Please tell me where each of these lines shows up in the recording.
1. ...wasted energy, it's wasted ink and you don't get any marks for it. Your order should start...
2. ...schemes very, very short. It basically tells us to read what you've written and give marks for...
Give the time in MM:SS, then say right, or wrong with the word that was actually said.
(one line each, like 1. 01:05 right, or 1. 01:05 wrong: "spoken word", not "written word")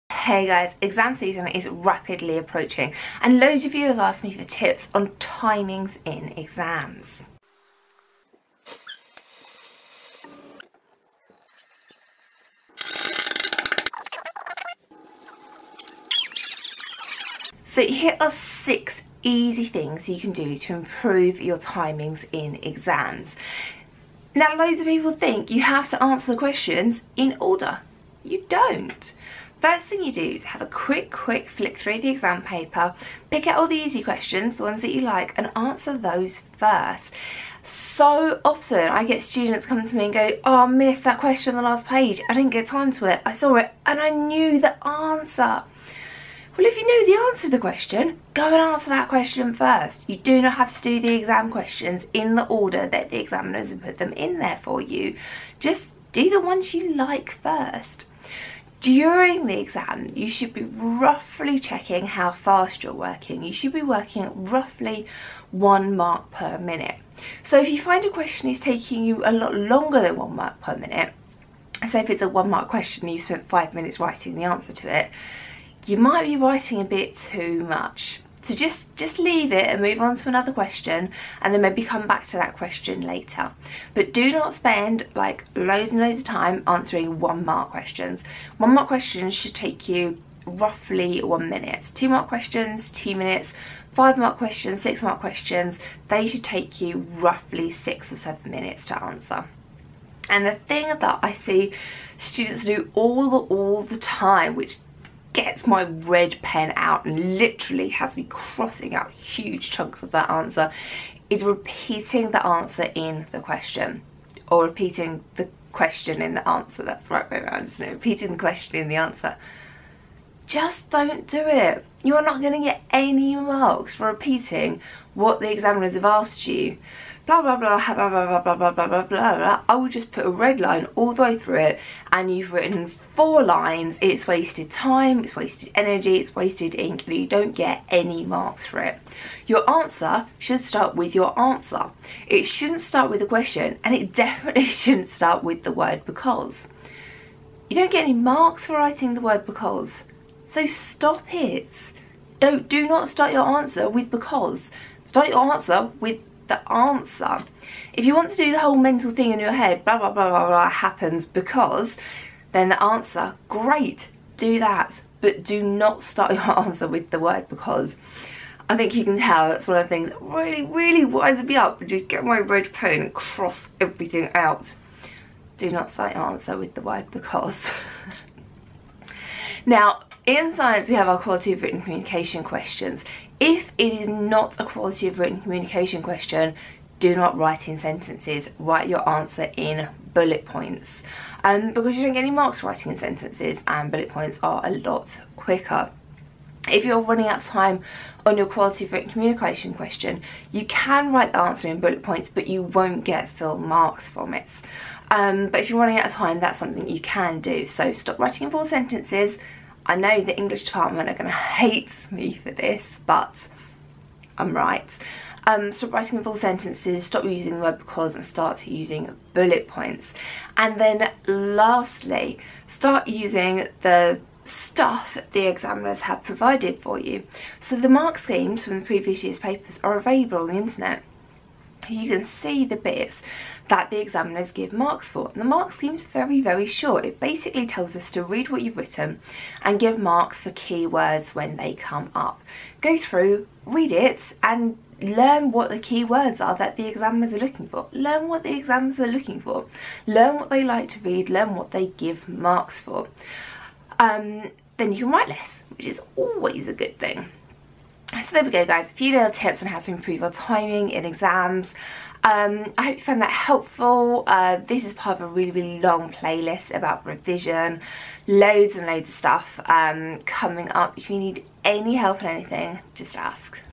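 1. 02:15 wrong: "answer", not "order"
2. 03:55 right.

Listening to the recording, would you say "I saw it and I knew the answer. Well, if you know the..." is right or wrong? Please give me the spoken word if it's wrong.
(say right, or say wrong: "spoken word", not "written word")
right.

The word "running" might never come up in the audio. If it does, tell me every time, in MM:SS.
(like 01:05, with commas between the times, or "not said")
03:17, 03:25.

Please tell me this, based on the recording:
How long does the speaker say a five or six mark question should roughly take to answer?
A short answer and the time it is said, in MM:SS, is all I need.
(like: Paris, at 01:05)
6 or 7 minutes, at 01:37.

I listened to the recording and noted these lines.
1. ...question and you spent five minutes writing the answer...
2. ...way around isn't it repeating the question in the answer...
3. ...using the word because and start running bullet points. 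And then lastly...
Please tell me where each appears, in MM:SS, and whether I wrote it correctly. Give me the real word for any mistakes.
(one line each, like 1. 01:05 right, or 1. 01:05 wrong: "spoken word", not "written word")
1. 01:12 right
2. 01:57 right
3. 03:37 wrong: "using", not "running".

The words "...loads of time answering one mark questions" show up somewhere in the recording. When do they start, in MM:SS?
01:26.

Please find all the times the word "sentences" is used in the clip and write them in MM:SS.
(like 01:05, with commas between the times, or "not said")
03:07, 03:12, 03:28, 03:36.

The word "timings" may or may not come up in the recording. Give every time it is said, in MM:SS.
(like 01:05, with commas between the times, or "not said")
00:05, 00:21, 04:20.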